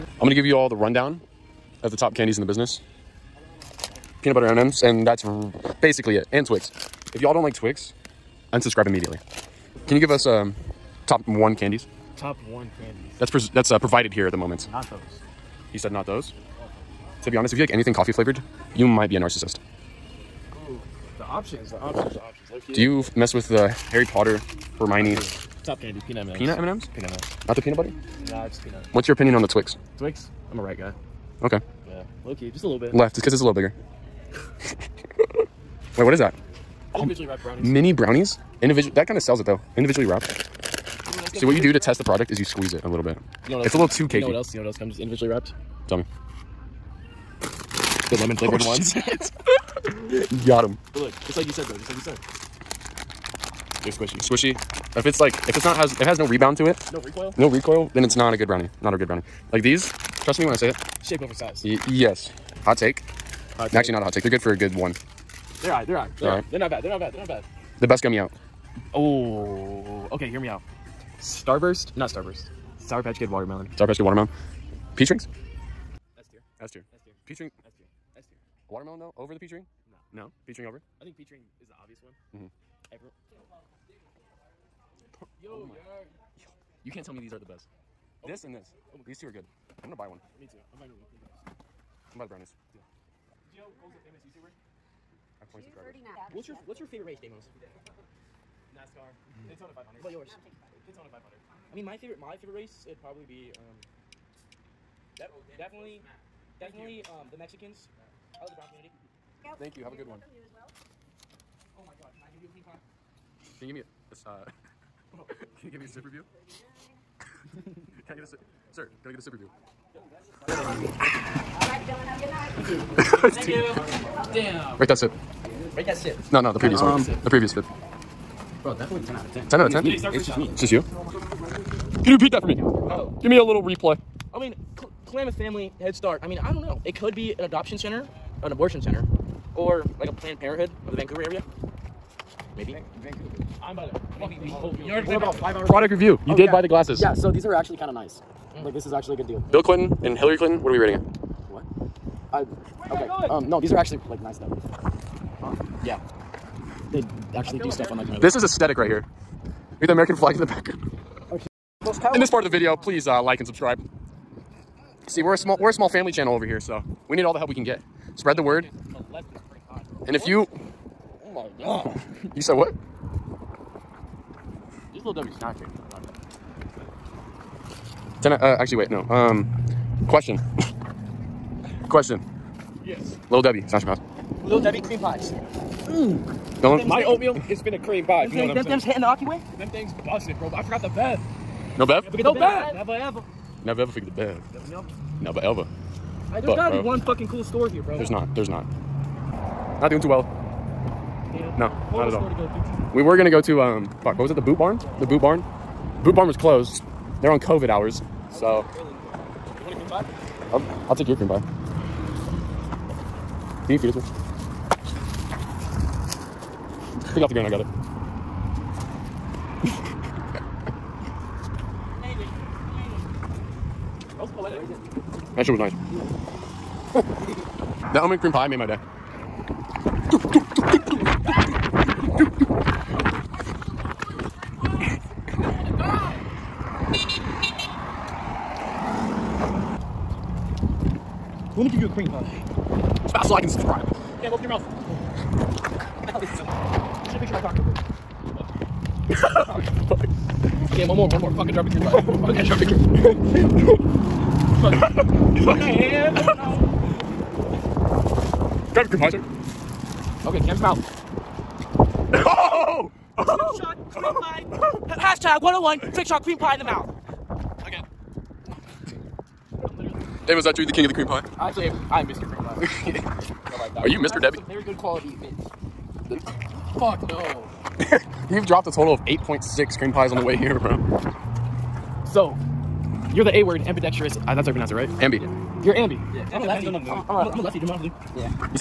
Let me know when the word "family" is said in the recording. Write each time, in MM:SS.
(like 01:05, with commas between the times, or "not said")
02:15, 02:45.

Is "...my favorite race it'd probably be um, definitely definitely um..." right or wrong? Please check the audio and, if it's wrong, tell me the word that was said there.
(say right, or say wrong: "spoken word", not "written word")
right.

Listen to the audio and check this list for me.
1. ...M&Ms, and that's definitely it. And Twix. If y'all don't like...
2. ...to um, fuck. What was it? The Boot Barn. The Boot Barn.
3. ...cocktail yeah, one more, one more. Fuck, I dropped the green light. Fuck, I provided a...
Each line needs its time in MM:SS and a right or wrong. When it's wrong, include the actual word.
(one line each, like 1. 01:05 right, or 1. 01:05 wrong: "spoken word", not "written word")
1. 00:04 wrong: "basically", not "definitely"
2. 03:23 right
3. 04:07 wrong: "dropped", not "provided".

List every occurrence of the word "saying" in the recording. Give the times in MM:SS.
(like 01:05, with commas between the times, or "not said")
03:08.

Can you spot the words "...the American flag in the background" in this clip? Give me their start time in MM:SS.
02:39.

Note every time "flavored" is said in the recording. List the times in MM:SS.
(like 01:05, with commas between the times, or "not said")
00:18, 00:48.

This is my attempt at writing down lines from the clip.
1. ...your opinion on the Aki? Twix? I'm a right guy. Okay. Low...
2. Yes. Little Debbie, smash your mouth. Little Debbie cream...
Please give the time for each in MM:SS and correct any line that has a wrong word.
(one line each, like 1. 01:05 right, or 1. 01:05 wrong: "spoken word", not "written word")
1. 00:29 wrong: "Twix", not "Aki"
2. 03:02 right.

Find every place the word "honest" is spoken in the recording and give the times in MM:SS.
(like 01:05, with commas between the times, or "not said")
00:17, 04:47.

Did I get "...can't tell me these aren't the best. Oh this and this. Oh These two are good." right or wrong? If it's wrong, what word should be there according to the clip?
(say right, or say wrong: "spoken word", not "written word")
right.